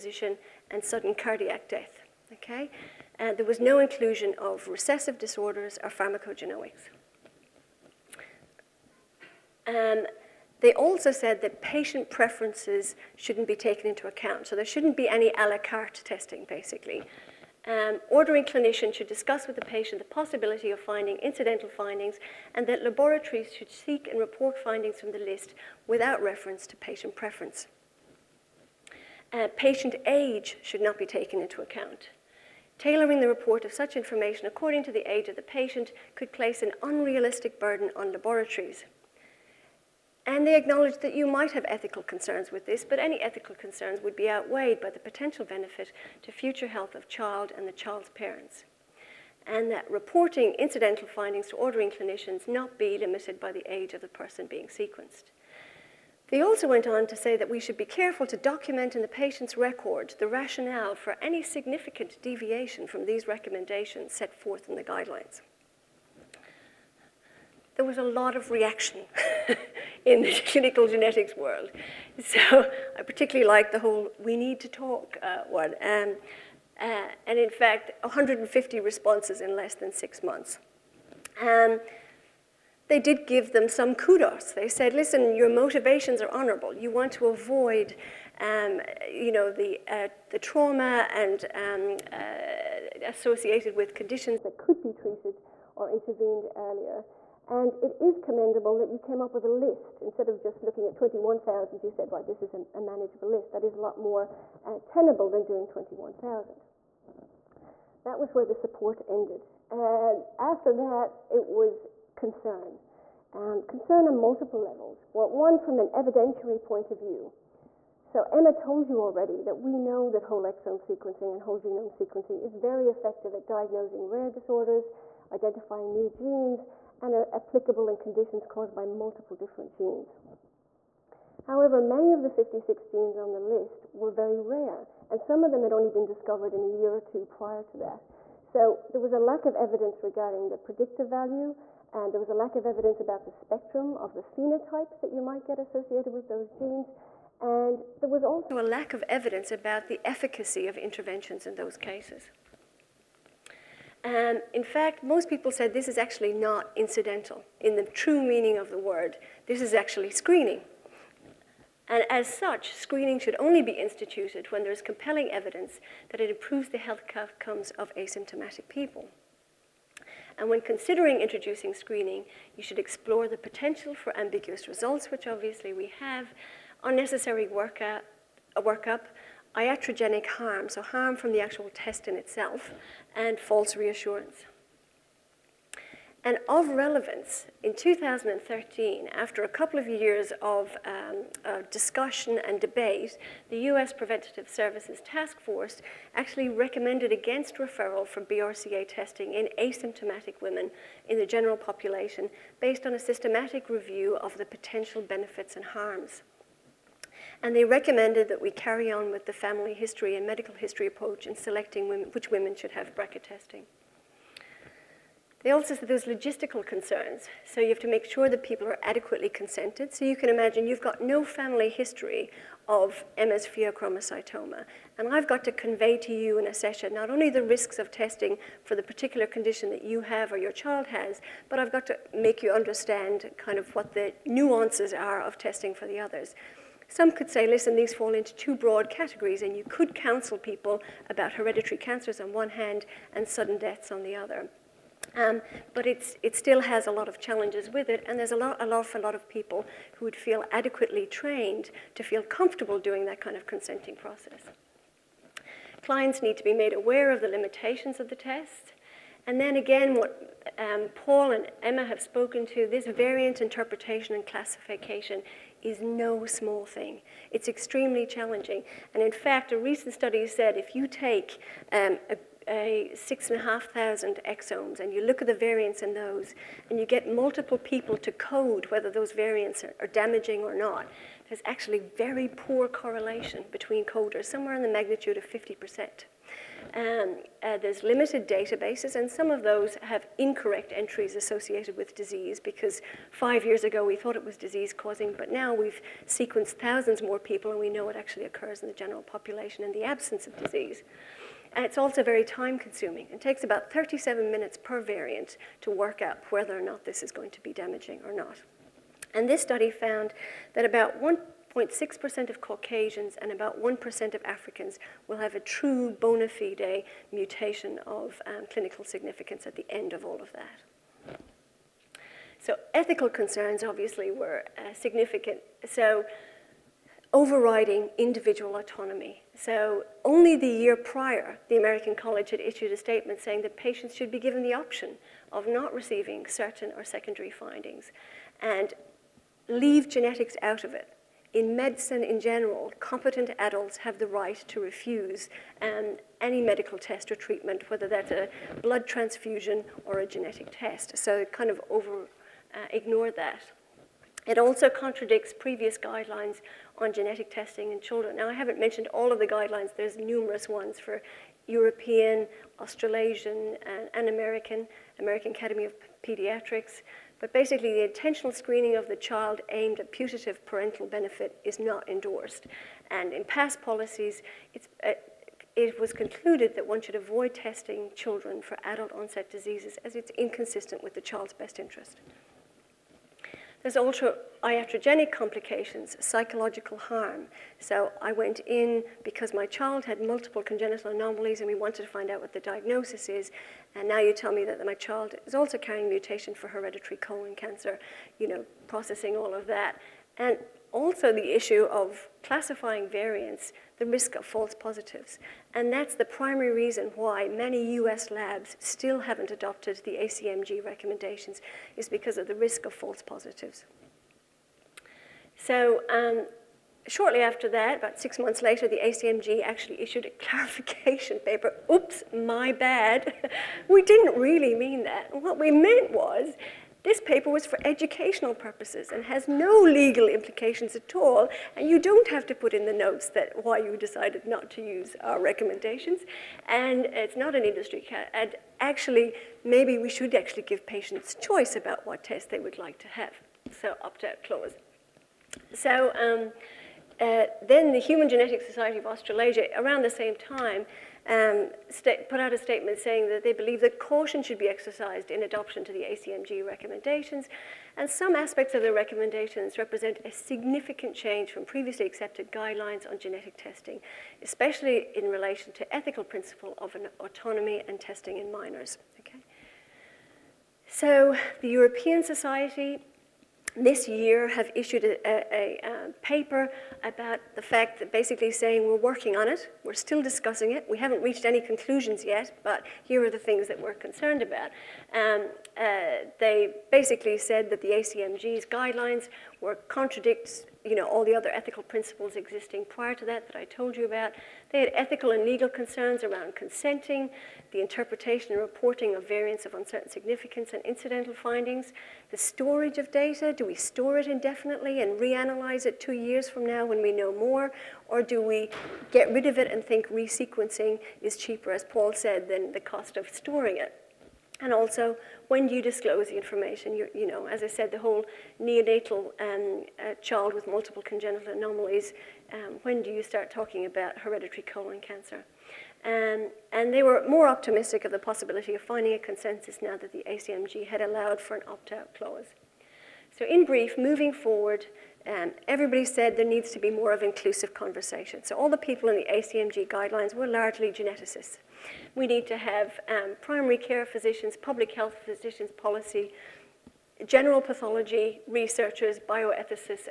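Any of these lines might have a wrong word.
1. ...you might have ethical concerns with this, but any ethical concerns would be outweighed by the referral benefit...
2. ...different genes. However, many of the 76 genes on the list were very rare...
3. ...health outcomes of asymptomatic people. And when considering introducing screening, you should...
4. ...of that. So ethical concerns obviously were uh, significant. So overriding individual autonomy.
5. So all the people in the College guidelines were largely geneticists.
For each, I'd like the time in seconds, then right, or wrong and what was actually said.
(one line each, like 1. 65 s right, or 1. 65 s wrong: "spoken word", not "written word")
1. 41 s wrong: "potential", not "referral"
2. 129 s wrong: "56", not "76"
3. 166 s right
4. 320 s right
5. 538 s wrong: "ACMG", not "College".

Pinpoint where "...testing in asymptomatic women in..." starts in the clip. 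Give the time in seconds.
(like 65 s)
198 s.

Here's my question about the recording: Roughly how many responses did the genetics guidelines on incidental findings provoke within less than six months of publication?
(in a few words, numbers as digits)
150.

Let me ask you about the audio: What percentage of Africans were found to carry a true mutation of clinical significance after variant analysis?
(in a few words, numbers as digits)
1%.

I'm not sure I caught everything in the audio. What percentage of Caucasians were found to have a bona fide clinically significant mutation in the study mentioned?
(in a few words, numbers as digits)
0.6%.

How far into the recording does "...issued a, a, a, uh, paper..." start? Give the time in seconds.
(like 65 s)
474 s.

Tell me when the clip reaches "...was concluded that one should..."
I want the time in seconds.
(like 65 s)
375 s.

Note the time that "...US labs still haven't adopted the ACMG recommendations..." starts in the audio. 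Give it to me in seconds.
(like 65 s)
407 s.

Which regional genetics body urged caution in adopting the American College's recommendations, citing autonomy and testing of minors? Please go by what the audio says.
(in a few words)
Human Genetics Society of Australasia.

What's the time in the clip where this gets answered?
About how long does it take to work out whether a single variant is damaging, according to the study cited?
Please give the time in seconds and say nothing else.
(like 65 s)
303 s.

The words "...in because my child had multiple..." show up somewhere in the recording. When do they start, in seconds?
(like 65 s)
388 s.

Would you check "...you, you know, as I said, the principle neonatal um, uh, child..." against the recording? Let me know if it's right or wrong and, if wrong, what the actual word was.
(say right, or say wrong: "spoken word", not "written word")
wrong: "whole", not "principle".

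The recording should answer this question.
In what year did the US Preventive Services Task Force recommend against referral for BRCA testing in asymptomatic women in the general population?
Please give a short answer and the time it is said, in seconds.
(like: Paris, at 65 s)
2013, at 187 s.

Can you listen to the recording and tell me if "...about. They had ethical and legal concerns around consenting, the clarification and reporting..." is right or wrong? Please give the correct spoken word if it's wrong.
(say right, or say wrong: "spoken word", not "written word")
wrong: "interpretation", not "clarification".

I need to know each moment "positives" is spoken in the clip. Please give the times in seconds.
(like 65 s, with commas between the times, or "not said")
404 s, 413 s.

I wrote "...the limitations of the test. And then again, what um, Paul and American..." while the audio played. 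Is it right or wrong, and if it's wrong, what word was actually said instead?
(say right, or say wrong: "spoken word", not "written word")
wrong: "Emma", not "American".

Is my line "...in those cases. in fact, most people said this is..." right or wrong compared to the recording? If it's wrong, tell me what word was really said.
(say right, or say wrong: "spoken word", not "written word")
right.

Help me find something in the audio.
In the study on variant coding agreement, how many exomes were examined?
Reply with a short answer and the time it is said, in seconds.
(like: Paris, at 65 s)
6,500, at 272 s.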